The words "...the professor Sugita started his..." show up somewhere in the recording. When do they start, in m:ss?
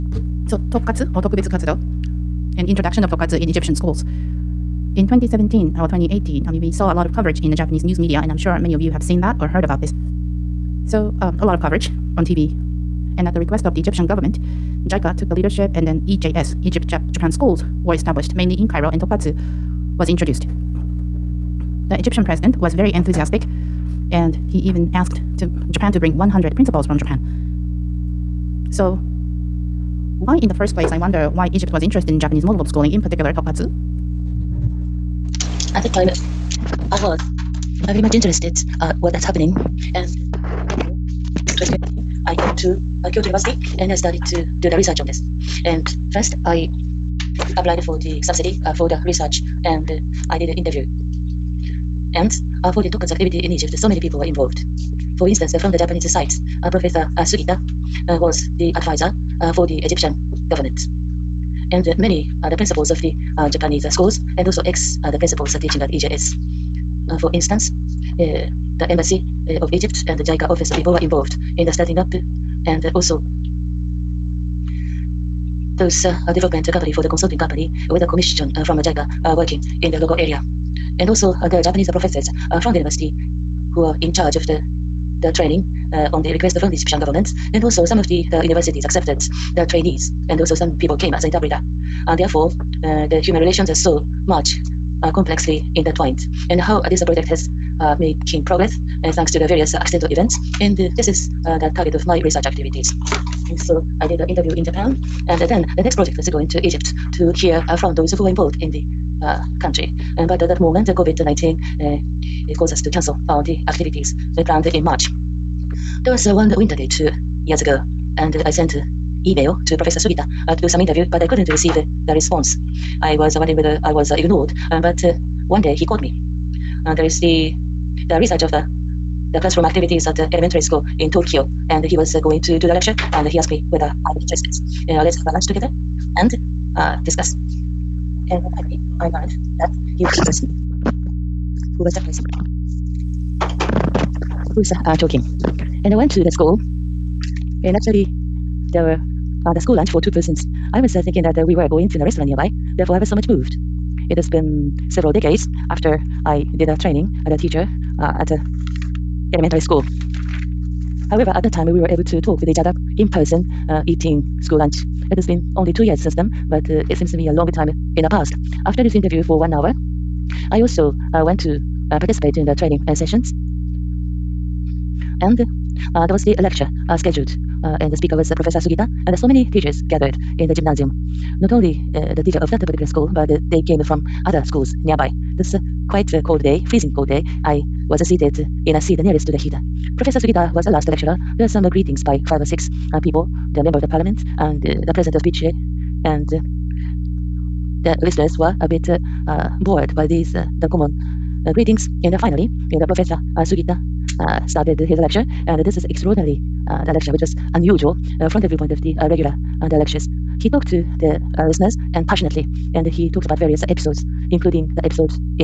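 3:22.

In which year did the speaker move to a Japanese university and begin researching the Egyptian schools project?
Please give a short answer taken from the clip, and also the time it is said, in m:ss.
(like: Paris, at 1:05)
2019, at 0:41.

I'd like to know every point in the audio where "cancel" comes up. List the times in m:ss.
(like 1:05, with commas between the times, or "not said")
1:52.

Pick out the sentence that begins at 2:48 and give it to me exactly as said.
After this interview for one hour, I also uh, went to uh, participate in the training uh, sessions.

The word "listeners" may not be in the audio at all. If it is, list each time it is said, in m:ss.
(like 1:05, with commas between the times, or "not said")
3:18, 3:31.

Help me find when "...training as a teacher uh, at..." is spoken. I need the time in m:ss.
2:36.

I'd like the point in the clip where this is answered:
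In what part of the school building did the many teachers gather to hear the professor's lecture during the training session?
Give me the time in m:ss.
3:00.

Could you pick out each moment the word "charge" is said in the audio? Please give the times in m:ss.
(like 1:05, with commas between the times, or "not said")
1:24.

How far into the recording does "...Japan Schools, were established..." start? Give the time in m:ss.
0:17.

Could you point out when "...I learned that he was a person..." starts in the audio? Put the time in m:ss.
2:19.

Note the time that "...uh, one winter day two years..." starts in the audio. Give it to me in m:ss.
1:56.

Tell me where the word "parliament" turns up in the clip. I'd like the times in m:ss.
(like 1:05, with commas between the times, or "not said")
3:13.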